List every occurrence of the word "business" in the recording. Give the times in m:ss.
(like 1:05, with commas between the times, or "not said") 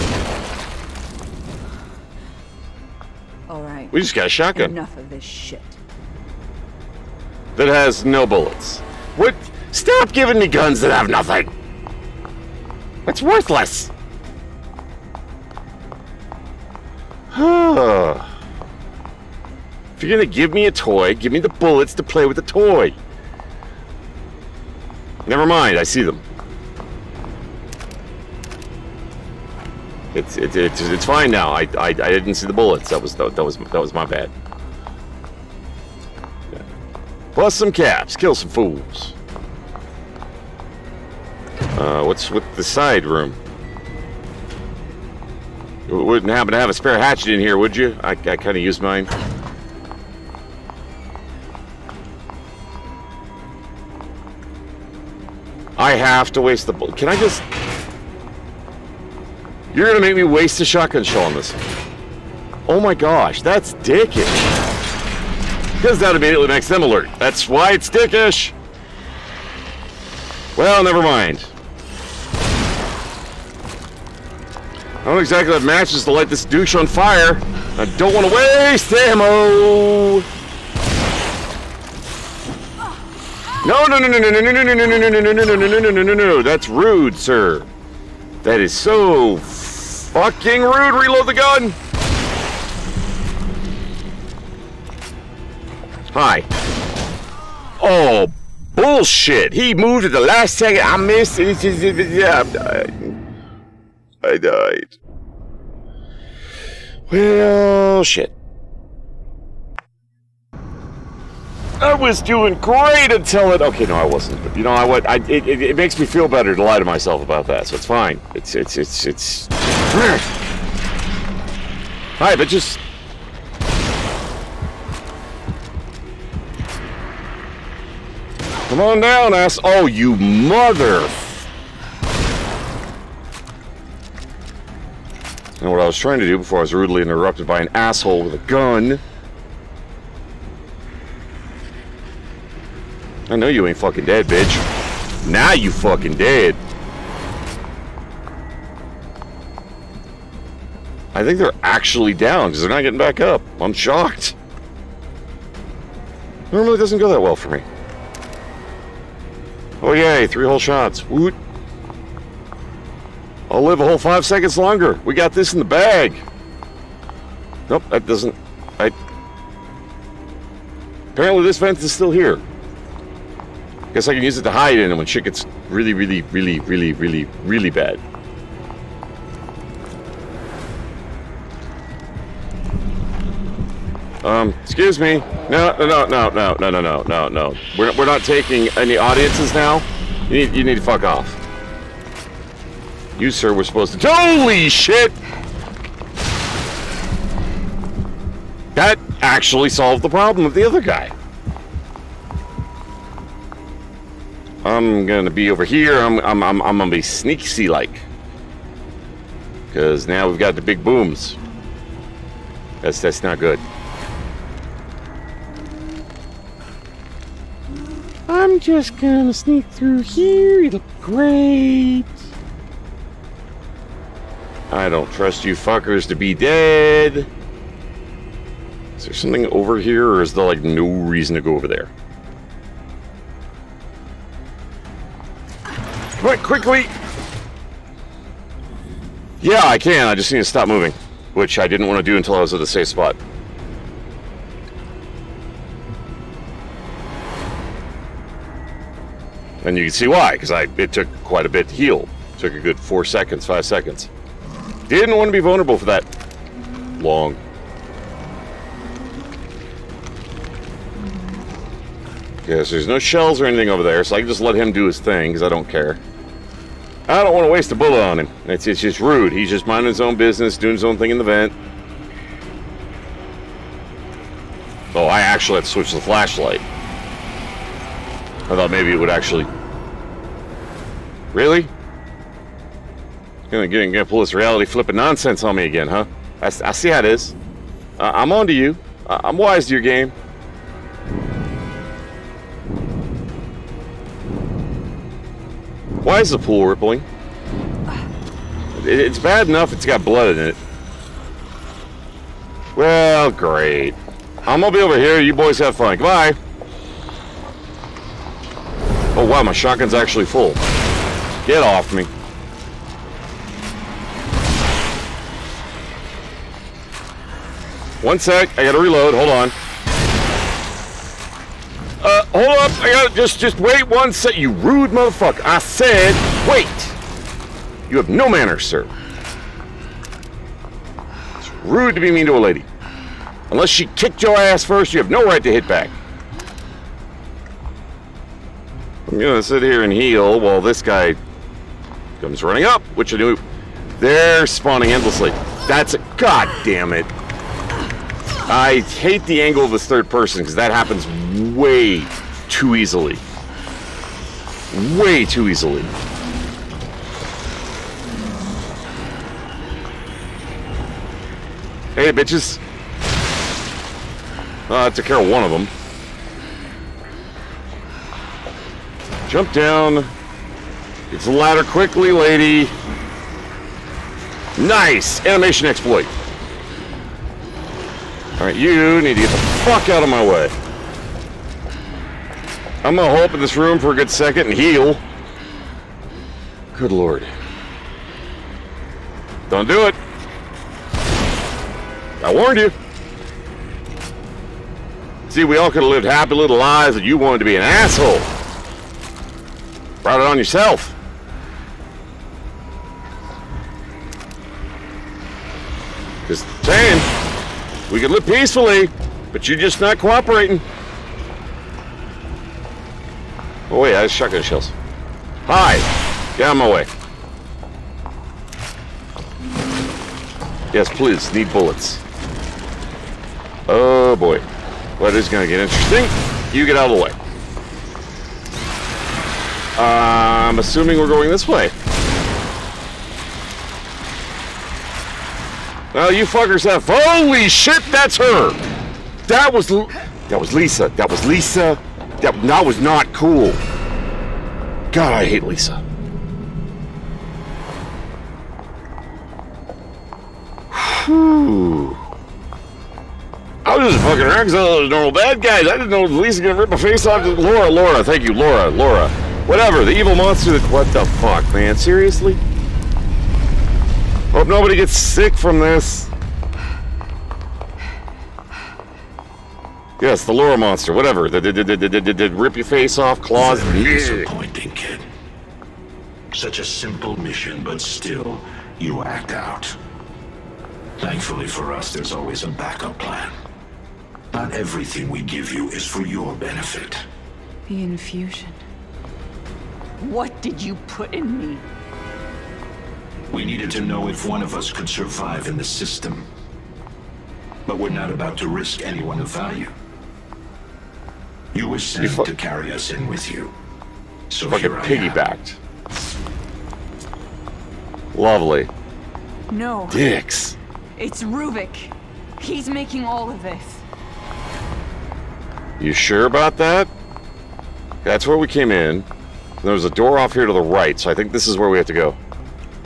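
4:30.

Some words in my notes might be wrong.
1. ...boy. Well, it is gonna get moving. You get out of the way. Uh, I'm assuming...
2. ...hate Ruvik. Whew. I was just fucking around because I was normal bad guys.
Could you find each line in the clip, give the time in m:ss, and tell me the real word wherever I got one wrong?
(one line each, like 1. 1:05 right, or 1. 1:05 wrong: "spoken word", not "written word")
1. 7:04 wrong: "interesting", not "moving"
2. 7:25 wrong: "Lisa", not "Ruvik".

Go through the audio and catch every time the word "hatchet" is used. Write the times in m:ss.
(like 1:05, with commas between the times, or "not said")
0:46.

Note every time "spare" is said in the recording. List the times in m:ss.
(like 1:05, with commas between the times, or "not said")
0:46.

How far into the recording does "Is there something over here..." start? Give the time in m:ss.
3:48.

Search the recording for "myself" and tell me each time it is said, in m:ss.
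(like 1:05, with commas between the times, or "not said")
1:56.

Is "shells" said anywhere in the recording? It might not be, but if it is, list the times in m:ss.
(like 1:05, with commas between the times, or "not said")
4:22, 6:54.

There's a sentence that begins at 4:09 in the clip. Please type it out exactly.
And you can see why, because I it took quite a bit to heal.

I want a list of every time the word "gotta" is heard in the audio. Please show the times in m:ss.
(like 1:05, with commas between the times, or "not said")
5:18, 5:22.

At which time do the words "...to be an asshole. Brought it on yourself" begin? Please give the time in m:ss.
6:37.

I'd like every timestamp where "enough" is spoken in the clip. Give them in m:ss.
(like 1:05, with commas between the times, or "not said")
0:04, 4:59.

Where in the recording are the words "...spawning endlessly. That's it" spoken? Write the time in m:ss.
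5:44.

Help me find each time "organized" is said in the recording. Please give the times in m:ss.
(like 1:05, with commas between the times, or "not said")
not said.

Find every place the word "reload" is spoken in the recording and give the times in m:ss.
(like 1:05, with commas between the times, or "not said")
1:30, 5:18.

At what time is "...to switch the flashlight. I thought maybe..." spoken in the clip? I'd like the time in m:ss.
4:35.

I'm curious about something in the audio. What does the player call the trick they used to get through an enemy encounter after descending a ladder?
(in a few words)
Animation exploit.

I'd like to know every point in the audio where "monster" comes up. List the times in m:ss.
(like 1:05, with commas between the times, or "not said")
7:40, 7:50.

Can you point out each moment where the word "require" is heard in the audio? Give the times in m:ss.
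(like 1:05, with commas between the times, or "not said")
not said.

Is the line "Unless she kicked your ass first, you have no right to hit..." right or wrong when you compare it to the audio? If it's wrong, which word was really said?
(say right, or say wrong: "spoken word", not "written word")
right.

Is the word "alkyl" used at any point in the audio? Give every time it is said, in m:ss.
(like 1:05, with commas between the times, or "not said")
not said.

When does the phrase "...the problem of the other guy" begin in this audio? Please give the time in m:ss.
3:20.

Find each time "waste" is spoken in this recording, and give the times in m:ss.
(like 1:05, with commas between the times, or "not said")
0:56, 4:27.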